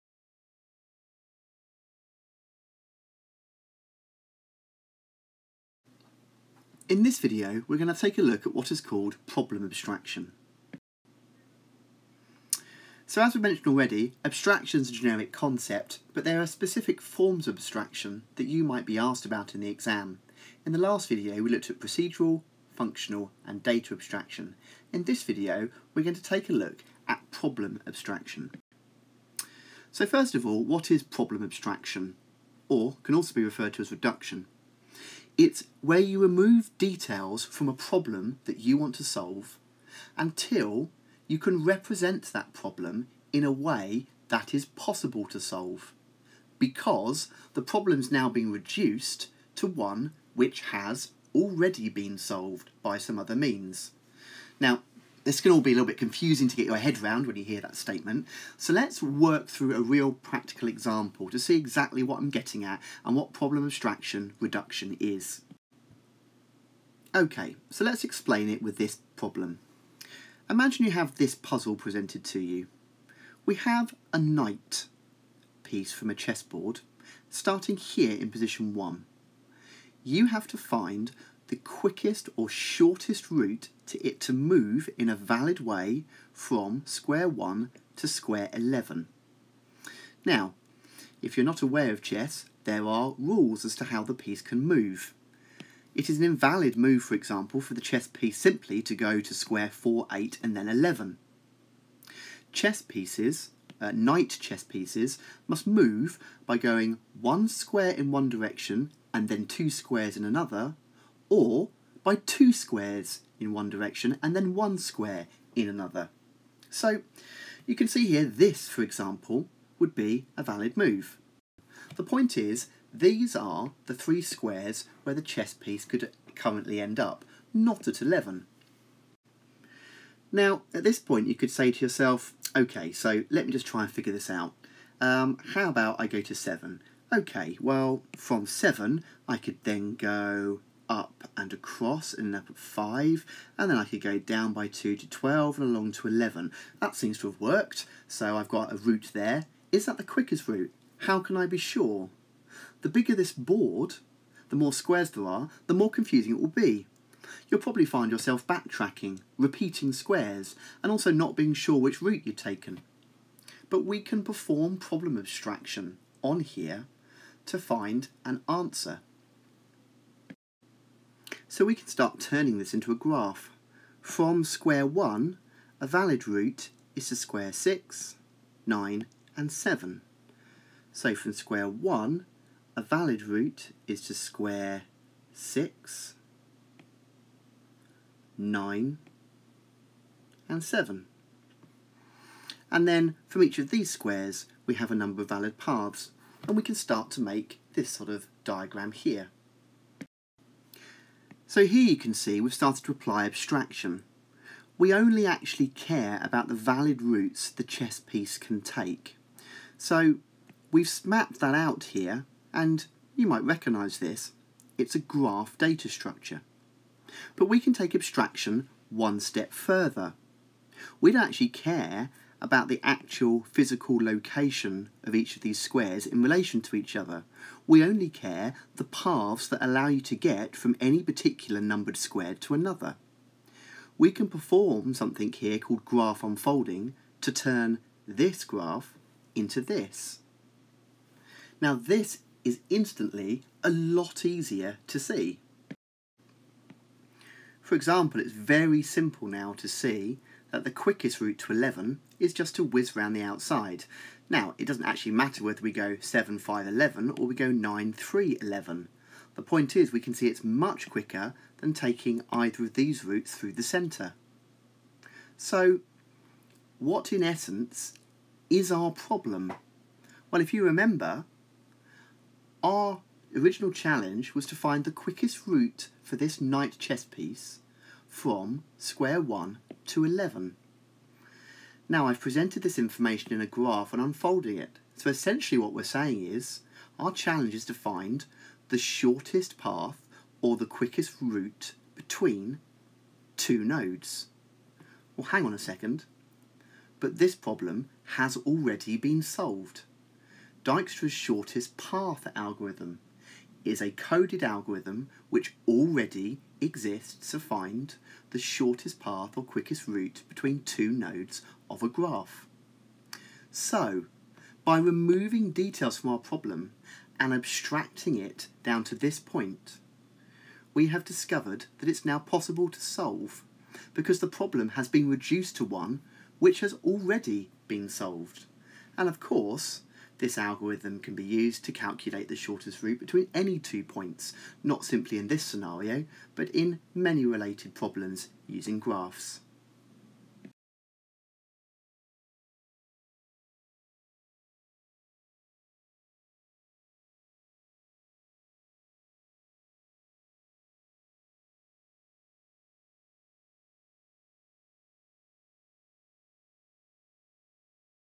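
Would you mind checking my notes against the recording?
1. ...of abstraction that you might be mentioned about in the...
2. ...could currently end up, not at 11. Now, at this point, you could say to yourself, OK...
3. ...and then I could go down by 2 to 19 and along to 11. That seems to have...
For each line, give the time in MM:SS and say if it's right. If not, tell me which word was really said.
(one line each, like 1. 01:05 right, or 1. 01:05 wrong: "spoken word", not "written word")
1. 00:17 wrong: "asked", not "mentioned"
2. 02:05 right
3. 02:23 wrong: "12", not "19".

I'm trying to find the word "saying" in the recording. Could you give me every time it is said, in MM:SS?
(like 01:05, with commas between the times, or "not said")
04:45.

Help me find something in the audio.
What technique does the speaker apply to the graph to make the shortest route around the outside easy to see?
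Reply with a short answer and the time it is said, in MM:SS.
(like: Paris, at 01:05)
graph unfolding, at 03:55.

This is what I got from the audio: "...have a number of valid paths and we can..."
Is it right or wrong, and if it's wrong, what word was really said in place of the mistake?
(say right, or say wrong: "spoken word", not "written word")
right.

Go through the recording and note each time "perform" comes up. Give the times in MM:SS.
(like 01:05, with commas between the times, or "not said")
02:44, 03:54.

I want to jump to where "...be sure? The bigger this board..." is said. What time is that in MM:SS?
02:31.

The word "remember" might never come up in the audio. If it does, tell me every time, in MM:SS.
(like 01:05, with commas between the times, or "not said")
04:30.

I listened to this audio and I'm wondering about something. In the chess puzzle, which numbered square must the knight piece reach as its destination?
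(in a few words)
11.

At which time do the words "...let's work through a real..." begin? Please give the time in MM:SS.
00:58.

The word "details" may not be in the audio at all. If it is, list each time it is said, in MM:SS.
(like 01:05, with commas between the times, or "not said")
00:36, 05:15.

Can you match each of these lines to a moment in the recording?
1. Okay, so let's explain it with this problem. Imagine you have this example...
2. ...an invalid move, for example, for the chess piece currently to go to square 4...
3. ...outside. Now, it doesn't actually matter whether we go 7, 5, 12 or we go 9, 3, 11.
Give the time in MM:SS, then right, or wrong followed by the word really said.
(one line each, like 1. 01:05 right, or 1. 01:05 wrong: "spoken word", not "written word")
1. 01:07 wrong: "puzzle", not "example"
2. 01:36 wrong: "simply", not "currently"
3. 04:13 wrong: "11", not "12".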